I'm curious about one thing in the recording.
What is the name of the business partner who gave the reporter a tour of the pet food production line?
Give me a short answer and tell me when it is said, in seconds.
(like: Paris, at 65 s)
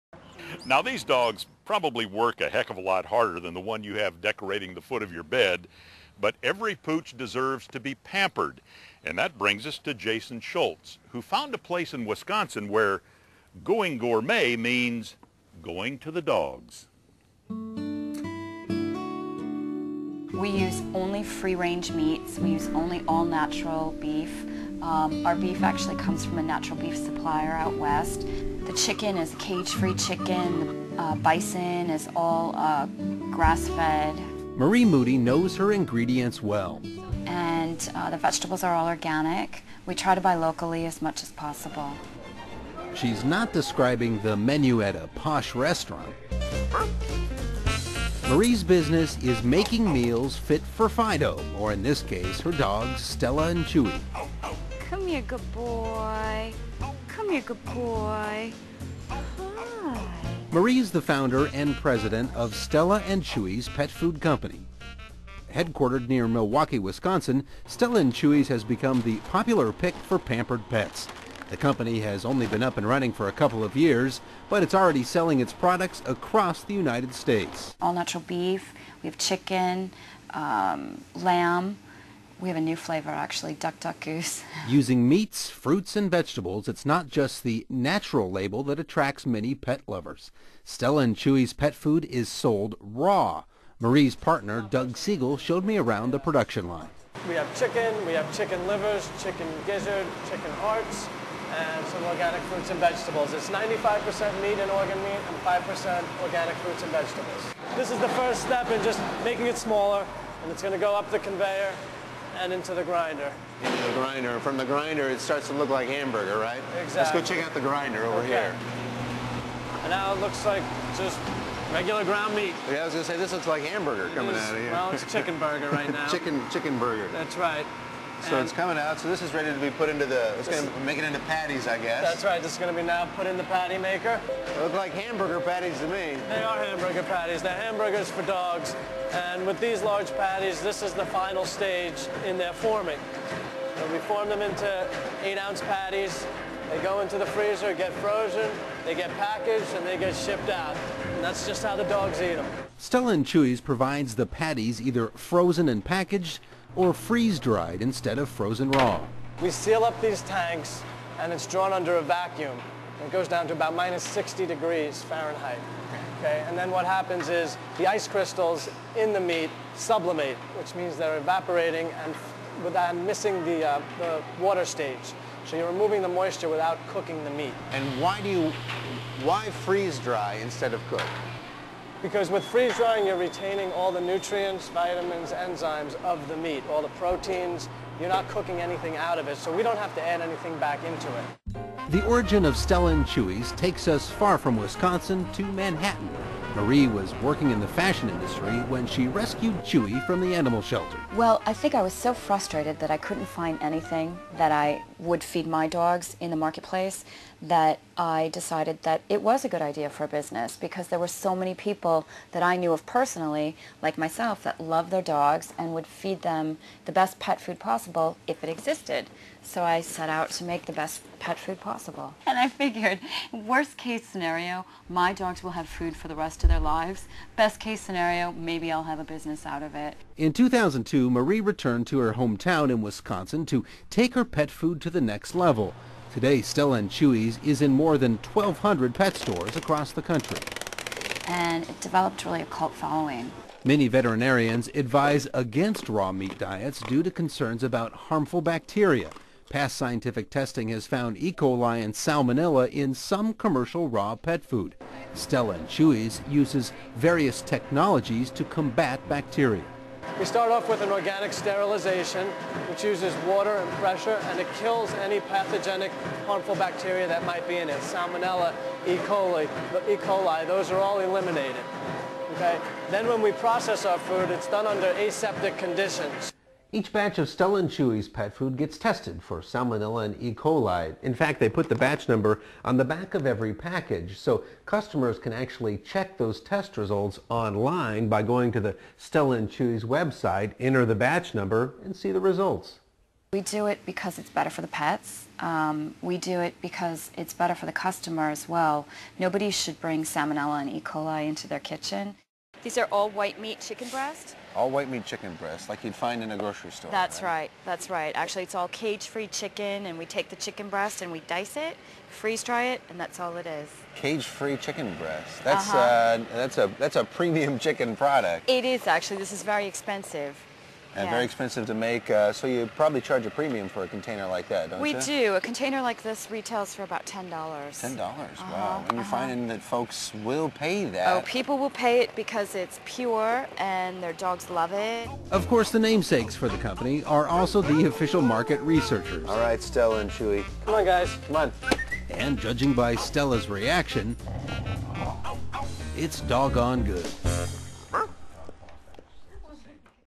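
Doug Siegal, at 94 s.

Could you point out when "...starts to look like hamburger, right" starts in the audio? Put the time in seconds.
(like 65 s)
115 s.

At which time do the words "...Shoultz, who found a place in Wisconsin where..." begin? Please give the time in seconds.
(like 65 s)
10 s.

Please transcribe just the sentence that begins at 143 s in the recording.
So we form them into eight-ounce patties.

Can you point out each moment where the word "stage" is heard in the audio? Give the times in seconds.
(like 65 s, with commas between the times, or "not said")
141 s, 174 s.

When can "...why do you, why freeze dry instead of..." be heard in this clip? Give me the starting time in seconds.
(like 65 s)
178 s.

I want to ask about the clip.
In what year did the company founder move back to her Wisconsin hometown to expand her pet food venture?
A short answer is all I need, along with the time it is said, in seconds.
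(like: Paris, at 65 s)
2002, at 230 s.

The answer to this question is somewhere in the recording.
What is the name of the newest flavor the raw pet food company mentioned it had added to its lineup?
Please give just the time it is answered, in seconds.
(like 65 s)
83 s.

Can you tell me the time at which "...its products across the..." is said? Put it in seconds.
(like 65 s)
75 s.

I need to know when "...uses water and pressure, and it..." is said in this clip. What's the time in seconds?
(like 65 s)
262 s.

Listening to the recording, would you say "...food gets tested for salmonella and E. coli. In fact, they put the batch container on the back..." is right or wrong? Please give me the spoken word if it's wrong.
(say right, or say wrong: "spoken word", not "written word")
wrong: "number", not "container".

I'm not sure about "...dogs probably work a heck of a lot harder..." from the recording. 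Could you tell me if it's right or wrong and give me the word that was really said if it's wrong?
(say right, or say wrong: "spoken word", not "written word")
right.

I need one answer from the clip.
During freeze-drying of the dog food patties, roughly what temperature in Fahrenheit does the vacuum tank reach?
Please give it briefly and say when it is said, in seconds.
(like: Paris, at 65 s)
-60 degrees, at 163 s.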